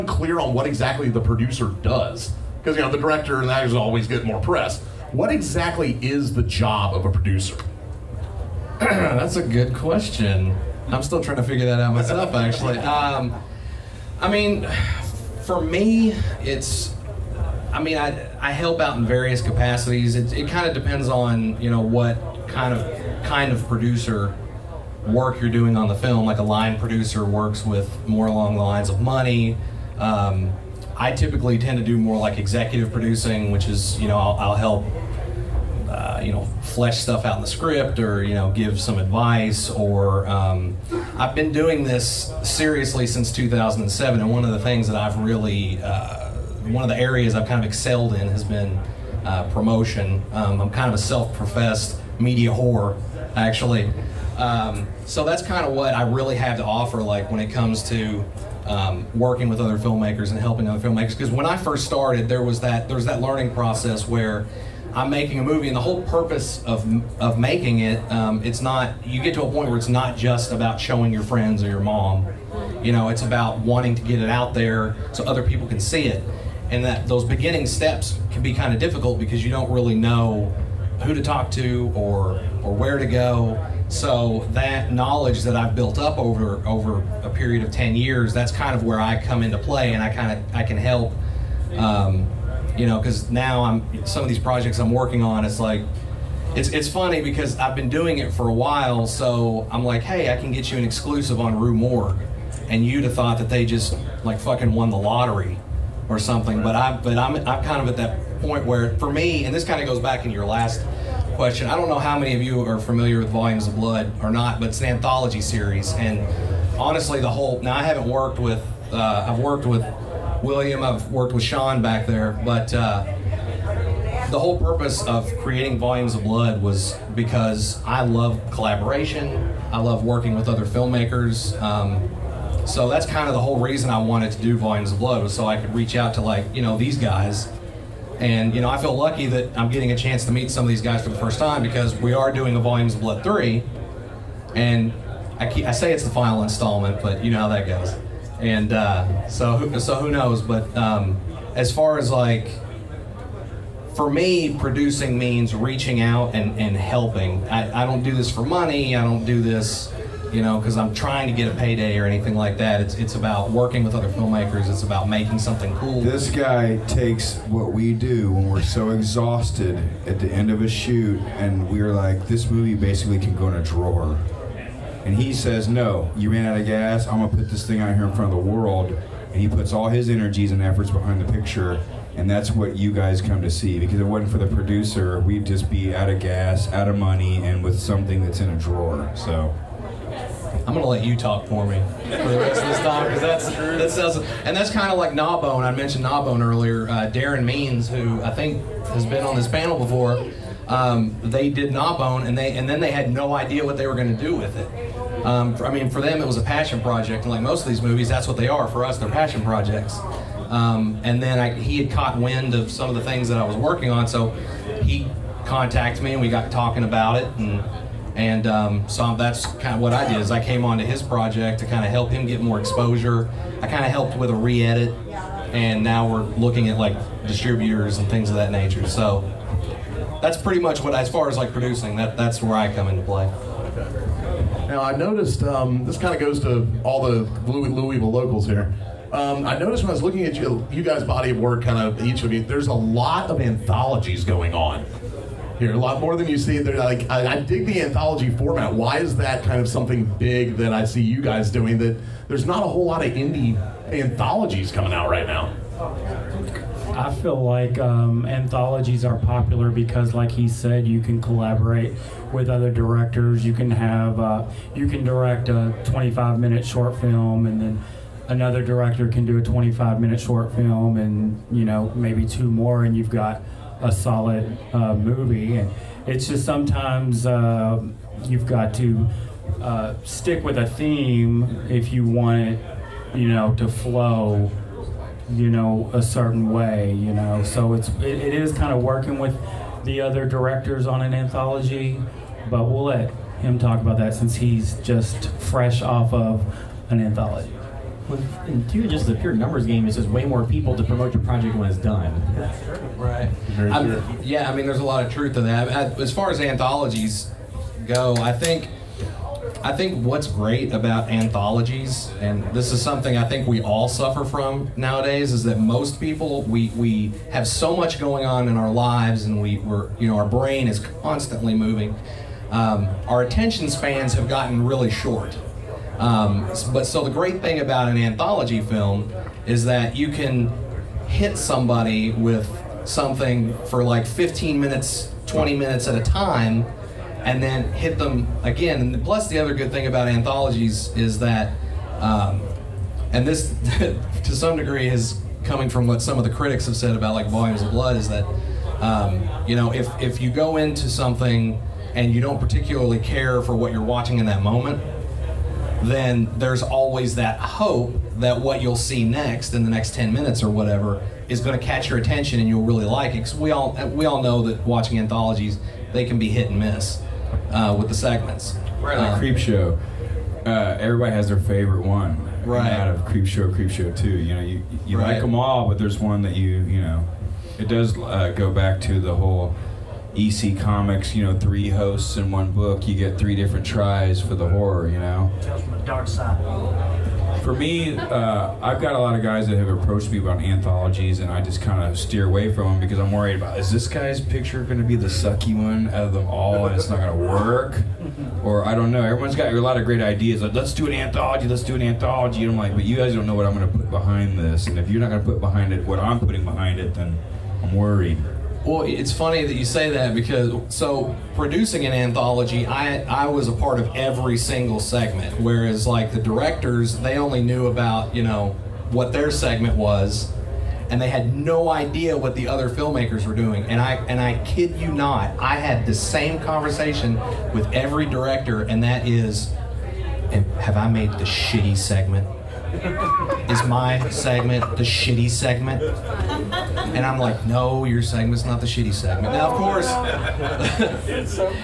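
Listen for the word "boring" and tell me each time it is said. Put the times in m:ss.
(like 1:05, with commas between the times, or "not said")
not said.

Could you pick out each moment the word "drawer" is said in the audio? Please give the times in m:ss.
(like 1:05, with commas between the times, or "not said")
2:53, 3:08.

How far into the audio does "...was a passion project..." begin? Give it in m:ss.
3:26.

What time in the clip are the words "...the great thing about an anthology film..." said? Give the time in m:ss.
5:27.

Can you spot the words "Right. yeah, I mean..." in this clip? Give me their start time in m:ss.
5:02.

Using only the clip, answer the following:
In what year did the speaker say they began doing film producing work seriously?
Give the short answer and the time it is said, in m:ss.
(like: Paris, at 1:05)
2007, at 0:43.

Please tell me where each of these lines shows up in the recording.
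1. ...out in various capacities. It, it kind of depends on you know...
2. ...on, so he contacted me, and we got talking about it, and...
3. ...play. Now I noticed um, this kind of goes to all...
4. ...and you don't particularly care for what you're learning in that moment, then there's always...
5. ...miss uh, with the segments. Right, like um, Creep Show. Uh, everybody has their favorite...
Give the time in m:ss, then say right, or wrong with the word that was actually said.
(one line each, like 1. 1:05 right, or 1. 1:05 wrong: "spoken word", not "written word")
1. 0:18 right
2. 3:33 right
3. 3:53 right
4. 5:51 wrong: "watching", not "learning"
5. 6:06 right.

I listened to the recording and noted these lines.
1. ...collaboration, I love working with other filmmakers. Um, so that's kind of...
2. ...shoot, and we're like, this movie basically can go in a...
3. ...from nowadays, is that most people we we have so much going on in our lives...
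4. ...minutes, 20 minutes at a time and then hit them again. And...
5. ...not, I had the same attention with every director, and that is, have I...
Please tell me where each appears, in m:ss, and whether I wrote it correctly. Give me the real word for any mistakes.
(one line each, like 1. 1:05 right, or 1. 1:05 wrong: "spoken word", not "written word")
1. 2:08 right
2. 2:50 right
3. 5:14 right
4. 5:34 right
5. 7:04 wrong: "conversation", not "attention".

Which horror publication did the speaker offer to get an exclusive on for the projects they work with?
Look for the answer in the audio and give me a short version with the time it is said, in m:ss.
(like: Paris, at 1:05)
Rue Morgue, at 1:41.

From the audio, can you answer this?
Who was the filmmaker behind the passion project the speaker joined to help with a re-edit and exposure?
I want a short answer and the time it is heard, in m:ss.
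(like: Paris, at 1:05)
Darren Means, at 3:17.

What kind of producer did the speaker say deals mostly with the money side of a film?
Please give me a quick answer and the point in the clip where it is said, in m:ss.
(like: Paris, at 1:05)
Line producer, at 0:26.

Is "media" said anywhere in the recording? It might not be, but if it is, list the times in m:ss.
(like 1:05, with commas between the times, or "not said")
0:52.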